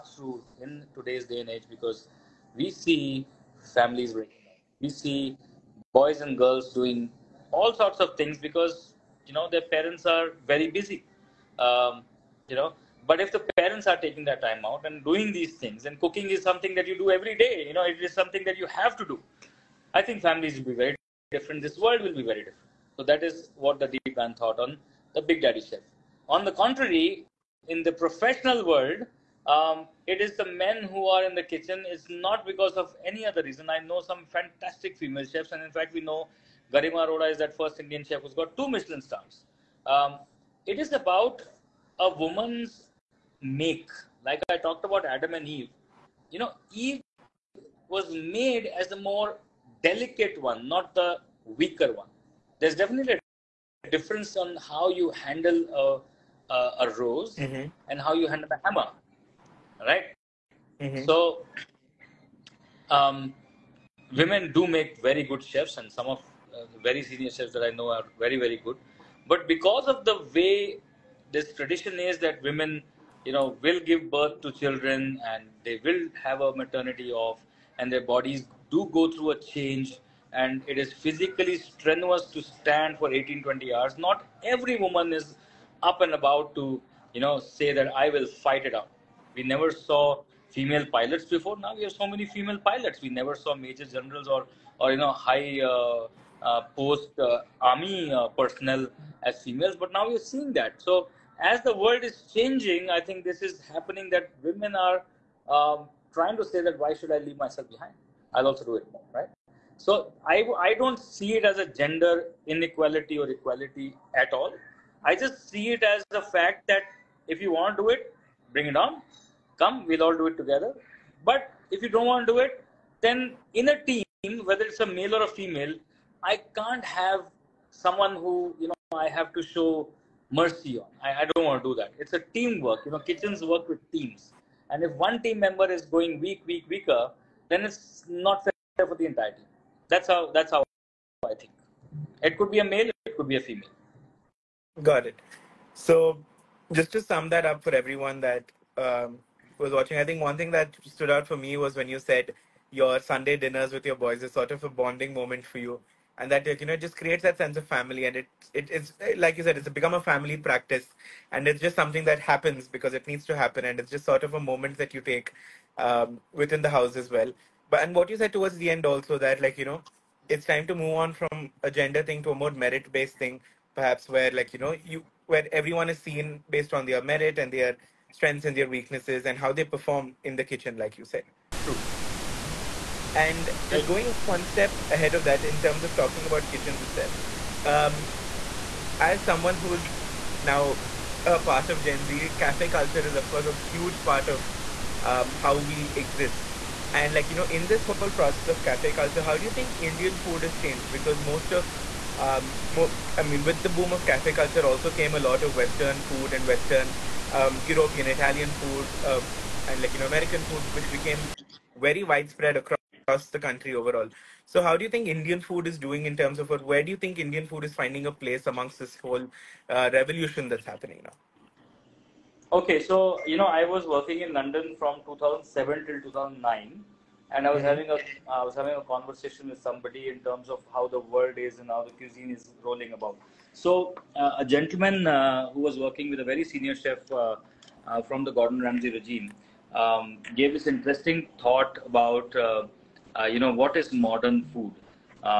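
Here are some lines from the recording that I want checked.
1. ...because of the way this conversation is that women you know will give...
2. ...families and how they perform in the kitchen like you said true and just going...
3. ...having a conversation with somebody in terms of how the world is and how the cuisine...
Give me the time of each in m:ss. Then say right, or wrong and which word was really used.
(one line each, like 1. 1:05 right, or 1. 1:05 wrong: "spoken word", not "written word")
1. 1:09 wrong: "tradition", not "conversation"
2. 2:58 wrong: "weaknesses", not "families"
3. 3:48 right.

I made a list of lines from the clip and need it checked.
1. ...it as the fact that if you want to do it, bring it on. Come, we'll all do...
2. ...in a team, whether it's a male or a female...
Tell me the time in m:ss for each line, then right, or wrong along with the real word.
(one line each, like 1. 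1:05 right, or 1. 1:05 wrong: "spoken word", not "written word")
1. 1:55 right
2. 2:03 right.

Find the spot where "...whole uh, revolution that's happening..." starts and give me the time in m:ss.
3:38.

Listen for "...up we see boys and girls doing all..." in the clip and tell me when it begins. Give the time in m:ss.
0:04.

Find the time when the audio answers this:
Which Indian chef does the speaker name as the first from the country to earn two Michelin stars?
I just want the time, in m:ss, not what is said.
0:36.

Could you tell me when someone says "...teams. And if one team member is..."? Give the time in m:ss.
2:13.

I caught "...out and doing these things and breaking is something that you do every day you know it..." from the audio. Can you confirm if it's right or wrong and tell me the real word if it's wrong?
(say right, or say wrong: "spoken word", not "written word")
wrong: "cooking", not "breaking".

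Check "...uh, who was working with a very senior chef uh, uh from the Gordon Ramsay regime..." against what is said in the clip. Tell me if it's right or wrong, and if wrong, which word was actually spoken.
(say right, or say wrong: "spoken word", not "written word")
right.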